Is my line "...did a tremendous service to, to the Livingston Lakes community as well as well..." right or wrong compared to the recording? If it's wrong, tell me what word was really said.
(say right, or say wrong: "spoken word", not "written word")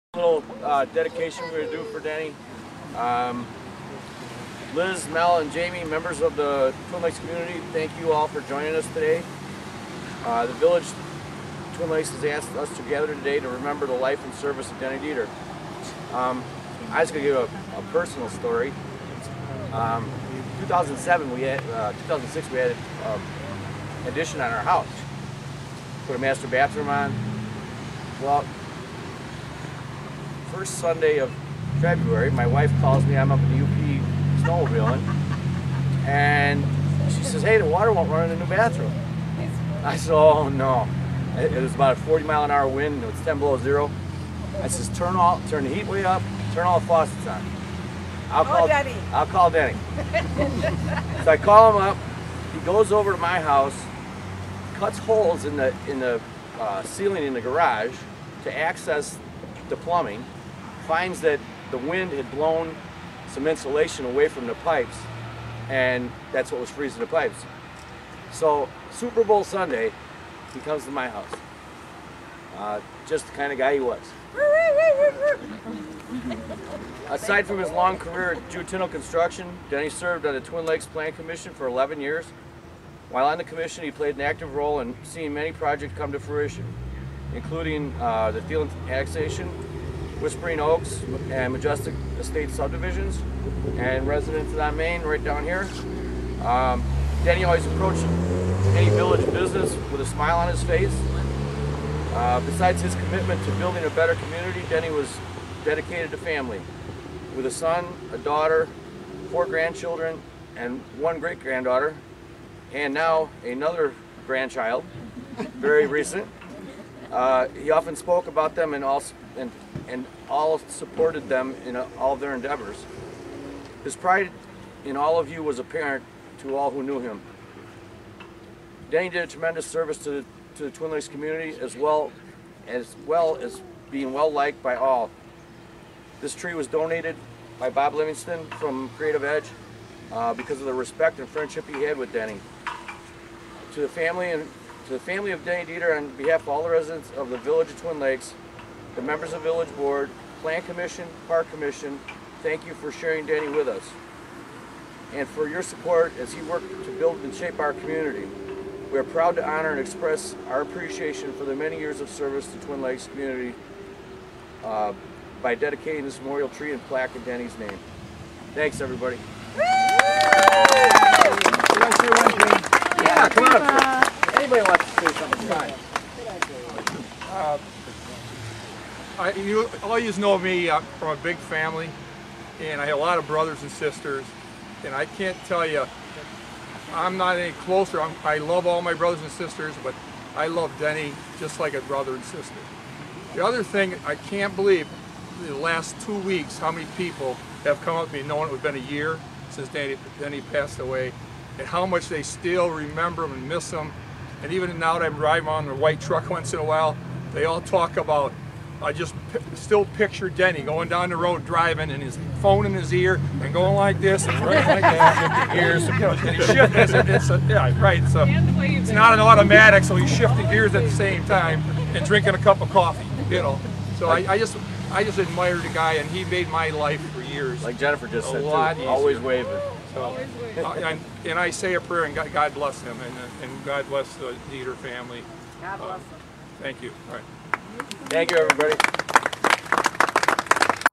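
wrong: "Twin", not "Livingston".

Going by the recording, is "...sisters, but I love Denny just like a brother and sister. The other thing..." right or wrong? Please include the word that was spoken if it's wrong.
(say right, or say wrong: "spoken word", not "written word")
right.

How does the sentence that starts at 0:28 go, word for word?
Well, first Sunday of February, my wife calls me.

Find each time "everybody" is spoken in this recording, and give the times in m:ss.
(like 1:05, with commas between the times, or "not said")
2:48, 3:58.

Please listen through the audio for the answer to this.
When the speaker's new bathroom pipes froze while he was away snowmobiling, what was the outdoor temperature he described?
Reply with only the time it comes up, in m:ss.
0:43.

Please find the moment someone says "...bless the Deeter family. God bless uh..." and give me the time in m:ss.
3:53.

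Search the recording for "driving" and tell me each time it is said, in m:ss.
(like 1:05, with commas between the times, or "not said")
3:25, 3:31.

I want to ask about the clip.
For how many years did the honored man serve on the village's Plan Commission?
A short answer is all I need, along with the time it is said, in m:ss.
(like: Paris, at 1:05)
11, at 1:21.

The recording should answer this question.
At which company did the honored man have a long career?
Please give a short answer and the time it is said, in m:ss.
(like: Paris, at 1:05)
Jutinal Construction, at 1:18.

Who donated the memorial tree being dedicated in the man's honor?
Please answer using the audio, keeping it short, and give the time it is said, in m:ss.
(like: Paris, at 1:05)
Bob Livingston, at 2:17.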